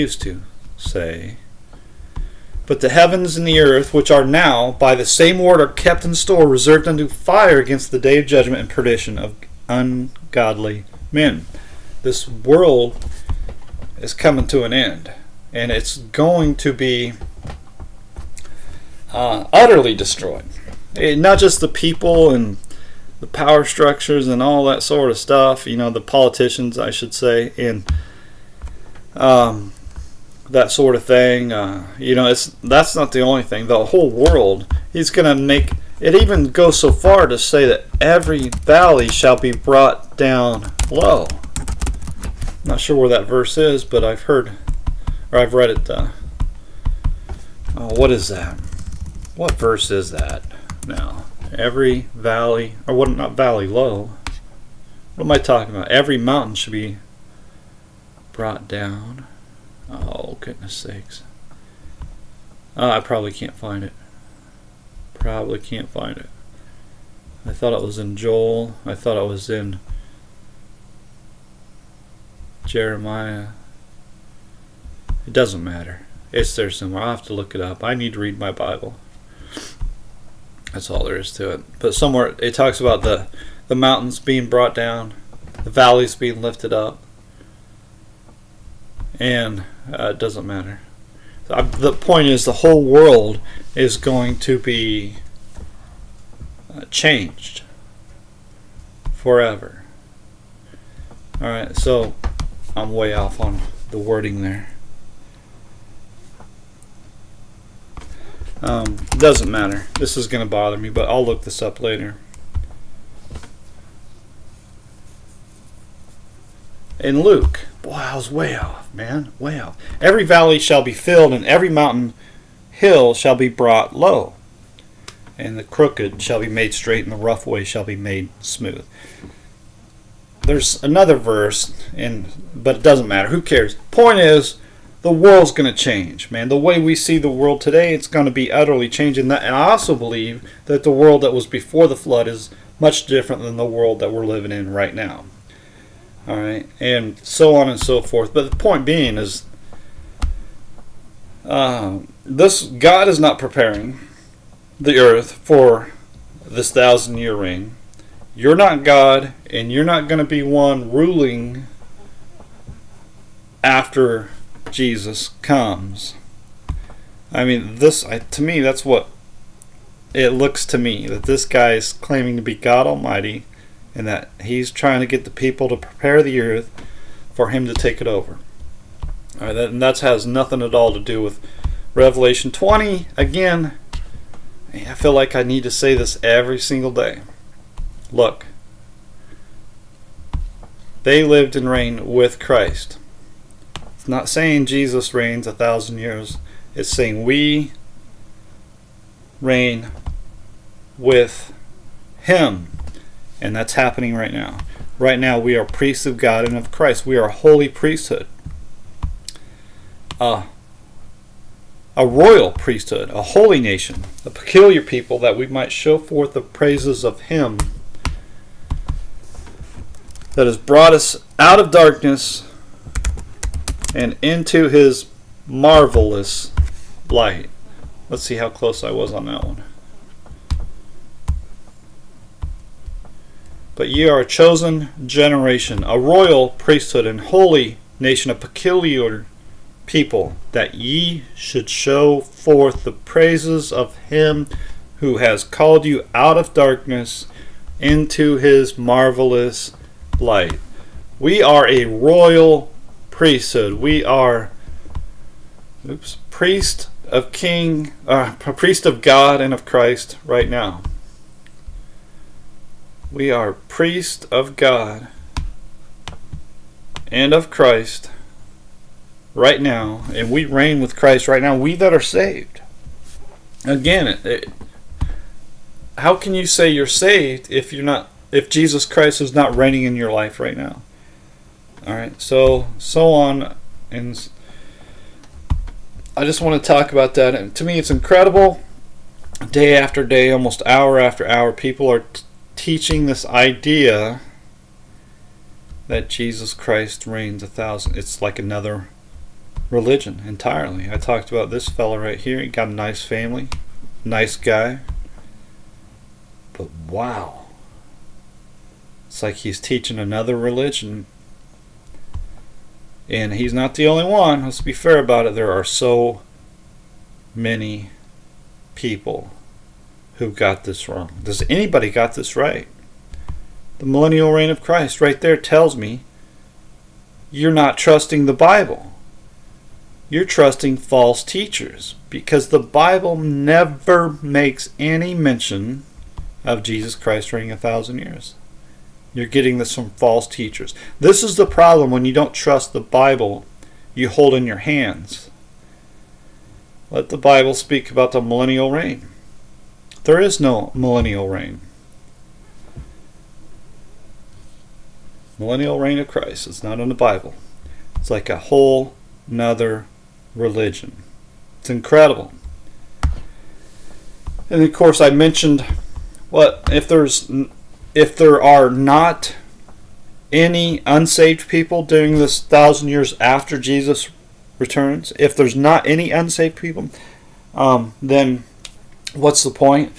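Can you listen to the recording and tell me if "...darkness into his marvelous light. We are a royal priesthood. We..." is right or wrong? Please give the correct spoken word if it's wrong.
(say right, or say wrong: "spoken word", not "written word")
right.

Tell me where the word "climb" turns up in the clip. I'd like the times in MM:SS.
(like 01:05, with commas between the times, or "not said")
not said.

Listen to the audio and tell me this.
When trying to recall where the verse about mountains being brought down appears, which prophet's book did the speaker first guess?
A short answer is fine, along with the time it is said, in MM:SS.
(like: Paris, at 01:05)
Joel, at 01:08.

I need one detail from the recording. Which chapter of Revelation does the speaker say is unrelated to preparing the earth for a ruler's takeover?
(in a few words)
20.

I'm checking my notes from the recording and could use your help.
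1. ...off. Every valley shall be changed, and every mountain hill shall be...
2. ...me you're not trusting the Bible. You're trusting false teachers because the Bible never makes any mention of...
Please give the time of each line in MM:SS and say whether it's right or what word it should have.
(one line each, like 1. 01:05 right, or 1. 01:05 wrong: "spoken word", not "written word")
1. 01:59 wrong: "filled", not "changed"
2. 05:25 right.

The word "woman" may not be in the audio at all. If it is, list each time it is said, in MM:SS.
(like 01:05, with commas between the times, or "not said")
not said.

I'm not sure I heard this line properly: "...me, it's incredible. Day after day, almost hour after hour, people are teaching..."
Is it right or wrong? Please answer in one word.
right.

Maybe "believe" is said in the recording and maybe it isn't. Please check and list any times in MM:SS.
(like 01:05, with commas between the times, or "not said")
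02:19.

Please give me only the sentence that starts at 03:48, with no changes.
Let's see how close I was on that one.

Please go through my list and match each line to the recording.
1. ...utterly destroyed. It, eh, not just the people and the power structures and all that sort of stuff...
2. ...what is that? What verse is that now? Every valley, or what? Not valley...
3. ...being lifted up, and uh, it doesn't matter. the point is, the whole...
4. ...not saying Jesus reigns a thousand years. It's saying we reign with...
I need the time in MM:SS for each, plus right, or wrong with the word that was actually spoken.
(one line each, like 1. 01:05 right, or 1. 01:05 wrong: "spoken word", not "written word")
1. 00:19 right
2. 00:47 right
3. 01:26 right
4. 03:14 right.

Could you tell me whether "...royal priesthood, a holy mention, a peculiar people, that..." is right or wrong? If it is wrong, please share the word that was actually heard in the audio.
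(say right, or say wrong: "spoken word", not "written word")
wrong: "nation", not "mention".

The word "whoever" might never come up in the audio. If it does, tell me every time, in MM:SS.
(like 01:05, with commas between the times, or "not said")
not said.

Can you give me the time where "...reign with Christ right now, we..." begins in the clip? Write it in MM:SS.
04:30.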